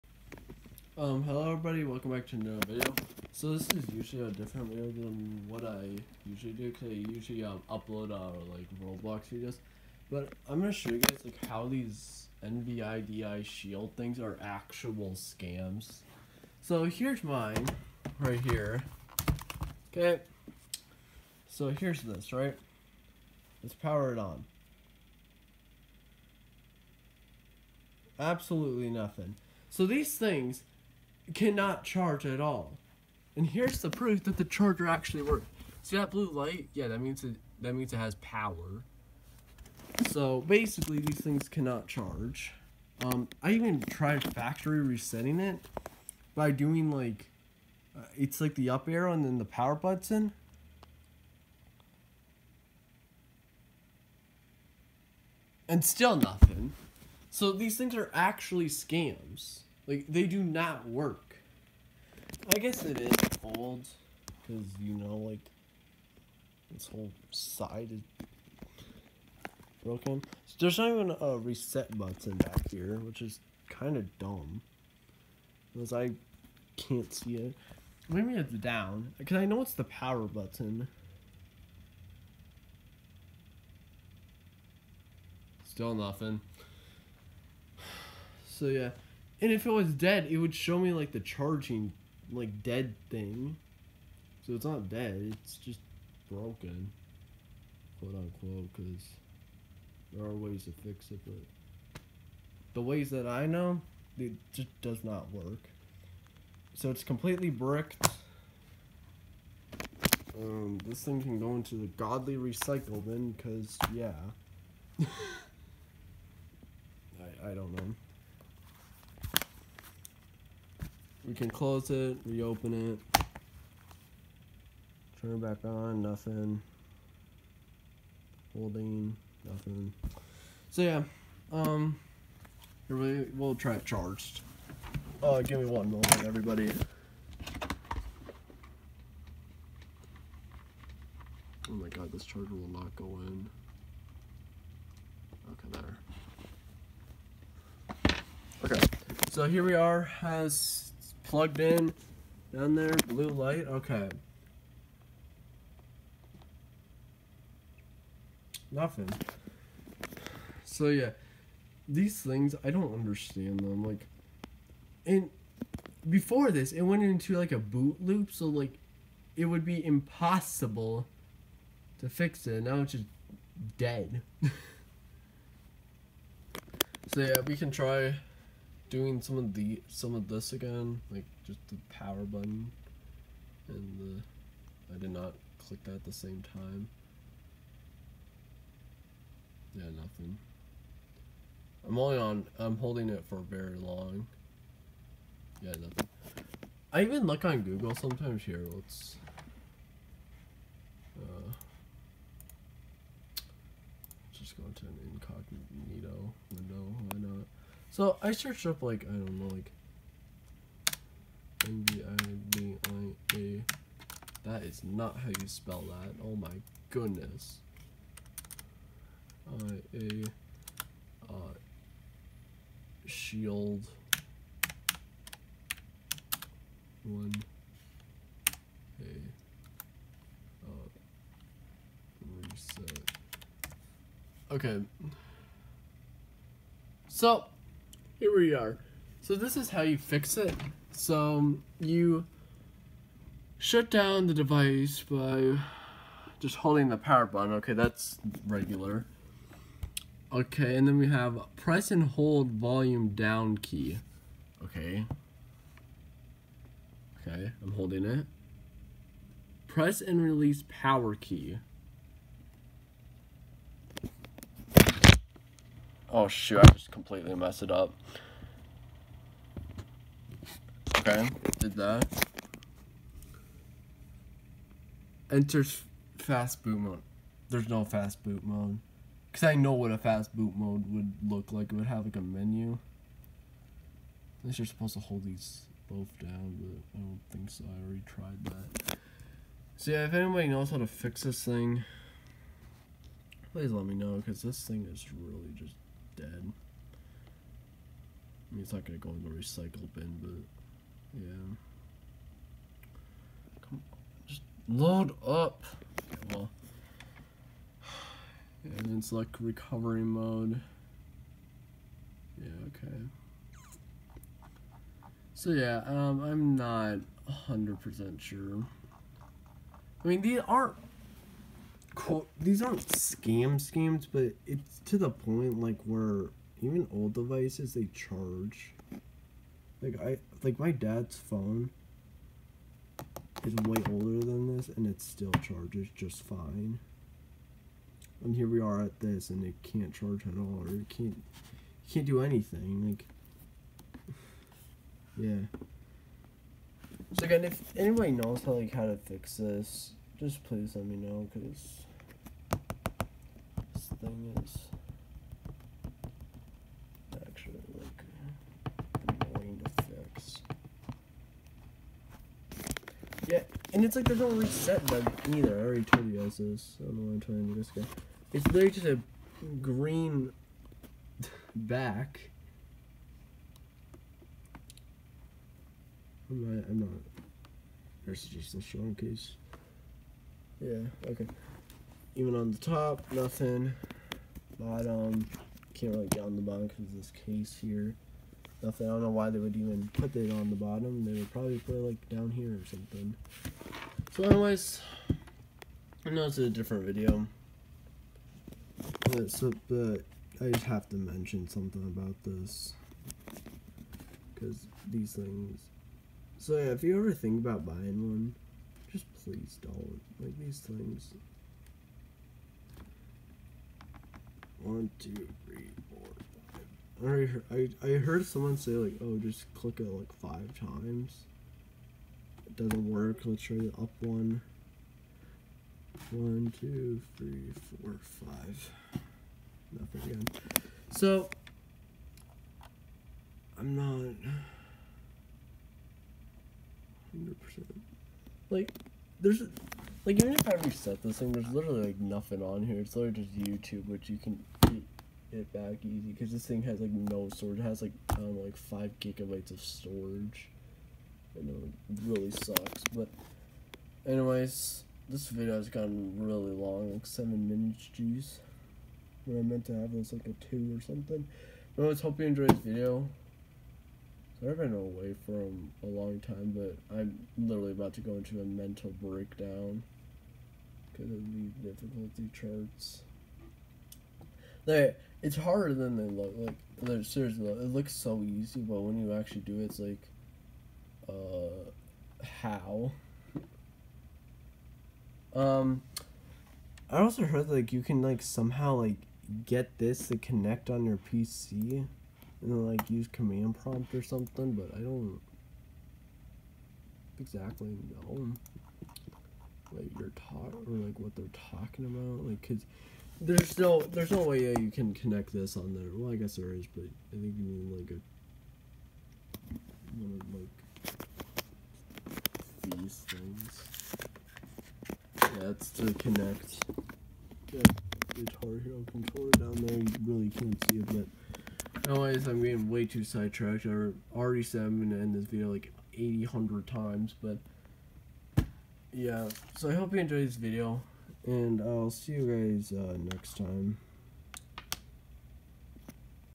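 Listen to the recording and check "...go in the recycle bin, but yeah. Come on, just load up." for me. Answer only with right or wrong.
right.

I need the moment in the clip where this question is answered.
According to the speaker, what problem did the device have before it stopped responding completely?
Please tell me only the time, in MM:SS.
02:47.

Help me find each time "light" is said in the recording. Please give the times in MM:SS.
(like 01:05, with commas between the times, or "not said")
00:36, 02:33.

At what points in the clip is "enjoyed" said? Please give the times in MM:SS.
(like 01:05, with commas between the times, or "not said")
07:42, 08:49.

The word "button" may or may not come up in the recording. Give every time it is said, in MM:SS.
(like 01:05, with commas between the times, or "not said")
00:49, 01:11, 01:20, 03:02, 04:07, 06:04.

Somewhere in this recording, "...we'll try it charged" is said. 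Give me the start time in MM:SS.
02:13.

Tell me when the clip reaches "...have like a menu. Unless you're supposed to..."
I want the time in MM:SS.
04:41.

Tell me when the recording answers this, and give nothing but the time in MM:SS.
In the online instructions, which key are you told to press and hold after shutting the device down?
04:12.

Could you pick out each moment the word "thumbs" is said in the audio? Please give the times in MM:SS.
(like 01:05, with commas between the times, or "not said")
not said.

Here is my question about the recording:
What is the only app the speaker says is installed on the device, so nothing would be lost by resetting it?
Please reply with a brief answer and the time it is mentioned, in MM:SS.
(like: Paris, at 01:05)
YouTube, at 07:23.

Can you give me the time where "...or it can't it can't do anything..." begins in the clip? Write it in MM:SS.
05:40.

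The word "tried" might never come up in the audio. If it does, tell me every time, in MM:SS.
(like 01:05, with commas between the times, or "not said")
00:43, 04:48.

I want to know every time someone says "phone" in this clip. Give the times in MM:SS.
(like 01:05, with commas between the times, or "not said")
05:31.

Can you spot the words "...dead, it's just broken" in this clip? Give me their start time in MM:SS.
01:34.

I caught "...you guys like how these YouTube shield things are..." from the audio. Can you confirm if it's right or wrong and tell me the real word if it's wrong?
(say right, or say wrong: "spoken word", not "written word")
wrong: "NVIDIA", not "YouTube".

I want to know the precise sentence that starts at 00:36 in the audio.
Yeah, that means it that means it has power.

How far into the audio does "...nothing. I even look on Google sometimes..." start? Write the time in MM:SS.
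03:15.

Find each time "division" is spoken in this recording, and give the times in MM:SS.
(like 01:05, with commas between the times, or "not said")
not said.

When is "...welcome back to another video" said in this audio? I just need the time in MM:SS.
00:01.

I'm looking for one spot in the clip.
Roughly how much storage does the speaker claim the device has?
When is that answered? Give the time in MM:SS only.
07:28.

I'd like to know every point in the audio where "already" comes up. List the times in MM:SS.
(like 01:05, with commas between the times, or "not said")
04:47, 06:05, 06:57, 08:44.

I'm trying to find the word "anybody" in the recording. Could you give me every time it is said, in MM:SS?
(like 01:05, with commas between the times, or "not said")
04:50, 05:47.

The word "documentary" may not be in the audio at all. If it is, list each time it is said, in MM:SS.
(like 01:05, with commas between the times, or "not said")
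not said.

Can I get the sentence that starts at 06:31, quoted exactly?
They would probably put it like down here or something.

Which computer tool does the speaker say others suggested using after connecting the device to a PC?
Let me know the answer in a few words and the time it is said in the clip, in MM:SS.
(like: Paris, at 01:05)
Command prompt, at 08:13.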